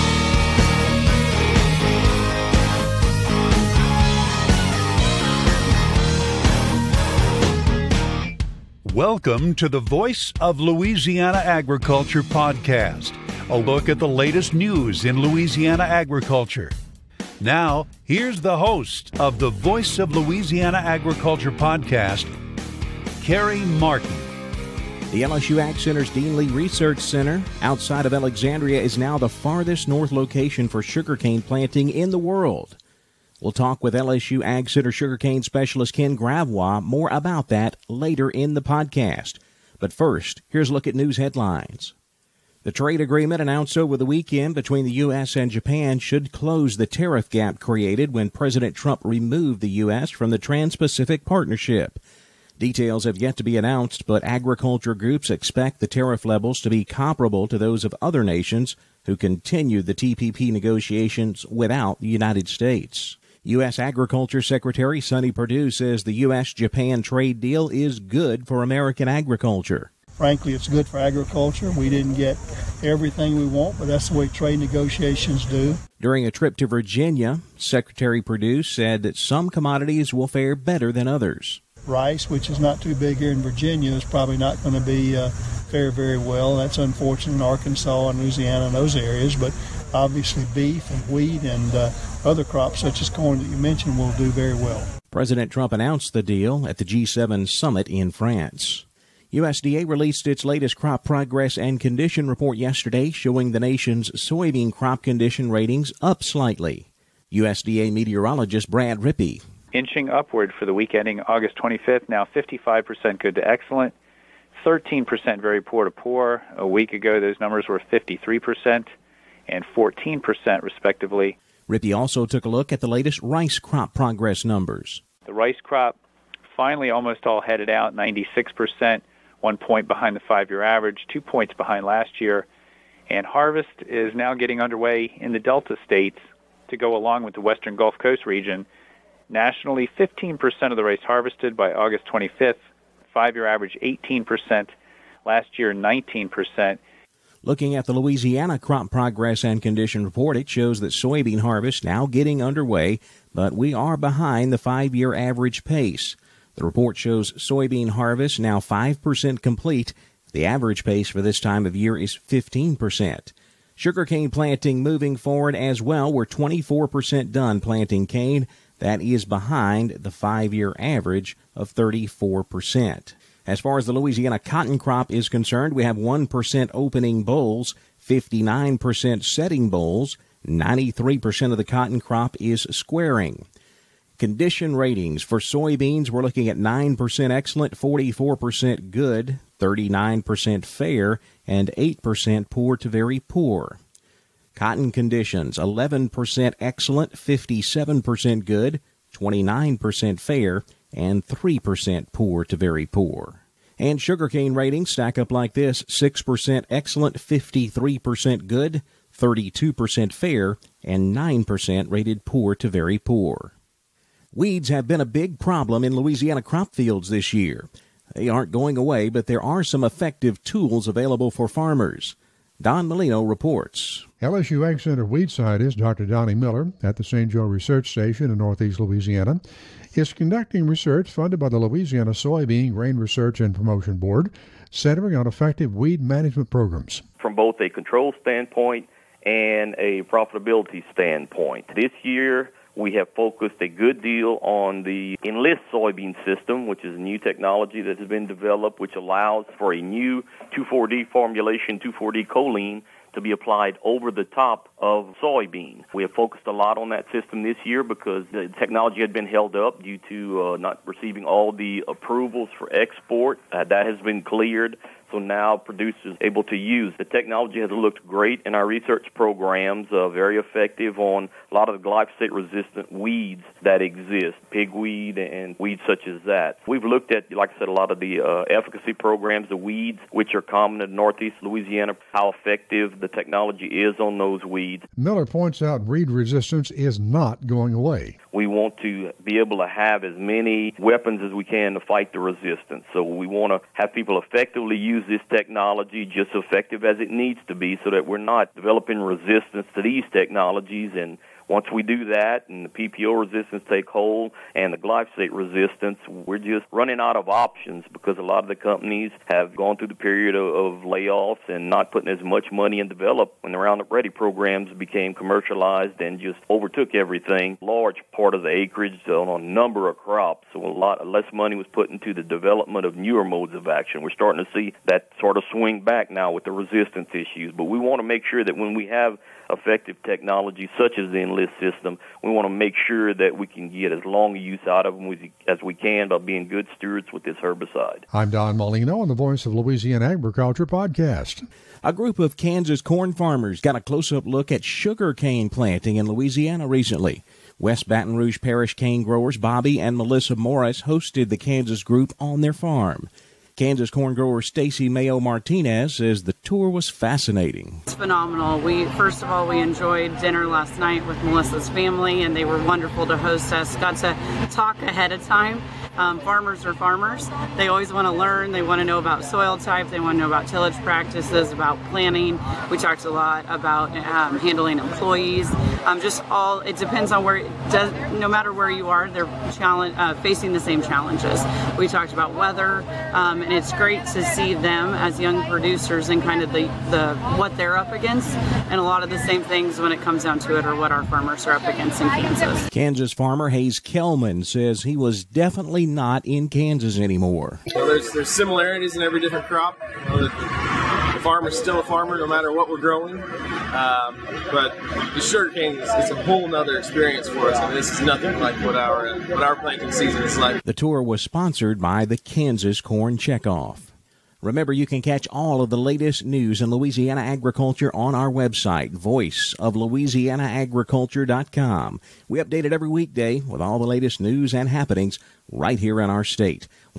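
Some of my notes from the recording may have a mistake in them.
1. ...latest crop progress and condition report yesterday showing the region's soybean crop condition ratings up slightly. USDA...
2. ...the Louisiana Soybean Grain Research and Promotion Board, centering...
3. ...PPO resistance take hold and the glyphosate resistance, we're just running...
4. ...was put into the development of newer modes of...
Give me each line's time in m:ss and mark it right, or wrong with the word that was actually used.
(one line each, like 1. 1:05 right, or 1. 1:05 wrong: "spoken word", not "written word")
1. 1:40 wrong: "nation", not "region"
2. 3:51 right
3. 5:02 right
4. 5:21 right.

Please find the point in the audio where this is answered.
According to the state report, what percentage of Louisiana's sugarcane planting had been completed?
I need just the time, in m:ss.
2:46.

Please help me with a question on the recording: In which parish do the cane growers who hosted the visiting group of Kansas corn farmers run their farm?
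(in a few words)
West Baton Rouge Parish.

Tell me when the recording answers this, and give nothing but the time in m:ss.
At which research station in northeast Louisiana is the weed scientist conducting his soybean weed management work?
3:47.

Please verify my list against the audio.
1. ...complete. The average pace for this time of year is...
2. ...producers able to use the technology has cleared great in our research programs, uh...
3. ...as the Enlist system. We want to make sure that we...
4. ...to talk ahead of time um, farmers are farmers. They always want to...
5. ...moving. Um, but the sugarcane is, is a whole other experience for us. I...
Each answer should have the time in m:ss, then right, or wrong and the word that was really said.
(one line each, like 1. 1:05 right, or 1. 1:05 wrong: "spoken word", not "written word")
1. 2:39 right
2. 4:25 wrong: "looked", not "cleared"
3. 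5:30 right
4. 6:03 right
5. 6:42 wrong: "growing", not "moving".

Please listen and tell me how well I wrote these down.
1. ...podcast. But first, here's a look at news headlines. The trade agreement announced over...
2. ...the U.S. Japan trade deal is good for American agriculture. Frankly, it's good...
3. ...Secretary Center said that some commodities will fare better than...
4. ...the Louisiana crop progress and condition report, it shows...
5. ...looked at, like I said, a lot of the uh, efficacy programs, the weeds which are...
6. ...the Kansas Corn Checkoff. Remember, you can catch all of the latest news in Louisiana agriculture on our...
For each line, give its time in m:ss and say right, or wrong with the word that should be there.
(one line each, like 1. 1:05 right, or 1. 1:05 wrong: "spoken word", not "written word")
1. 0:38 right
2. 1:06 right
3. 1:17 wrong: "Perdue", not "Center"
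4. 2:27 right
5. 4:36 right
6. 6:52 right.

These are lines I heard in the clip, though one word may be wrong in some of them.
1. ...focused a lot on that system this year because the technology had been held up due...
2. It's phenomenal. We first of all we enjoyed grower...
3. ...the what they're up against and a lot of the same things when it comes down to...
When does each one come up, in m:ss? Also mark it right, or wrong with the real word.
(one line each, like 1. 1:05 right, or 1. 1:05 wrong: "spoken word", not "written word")
1. 4:16 right
2. 5:57 wrong: "dinner", not "grower"
3. 6:26 right.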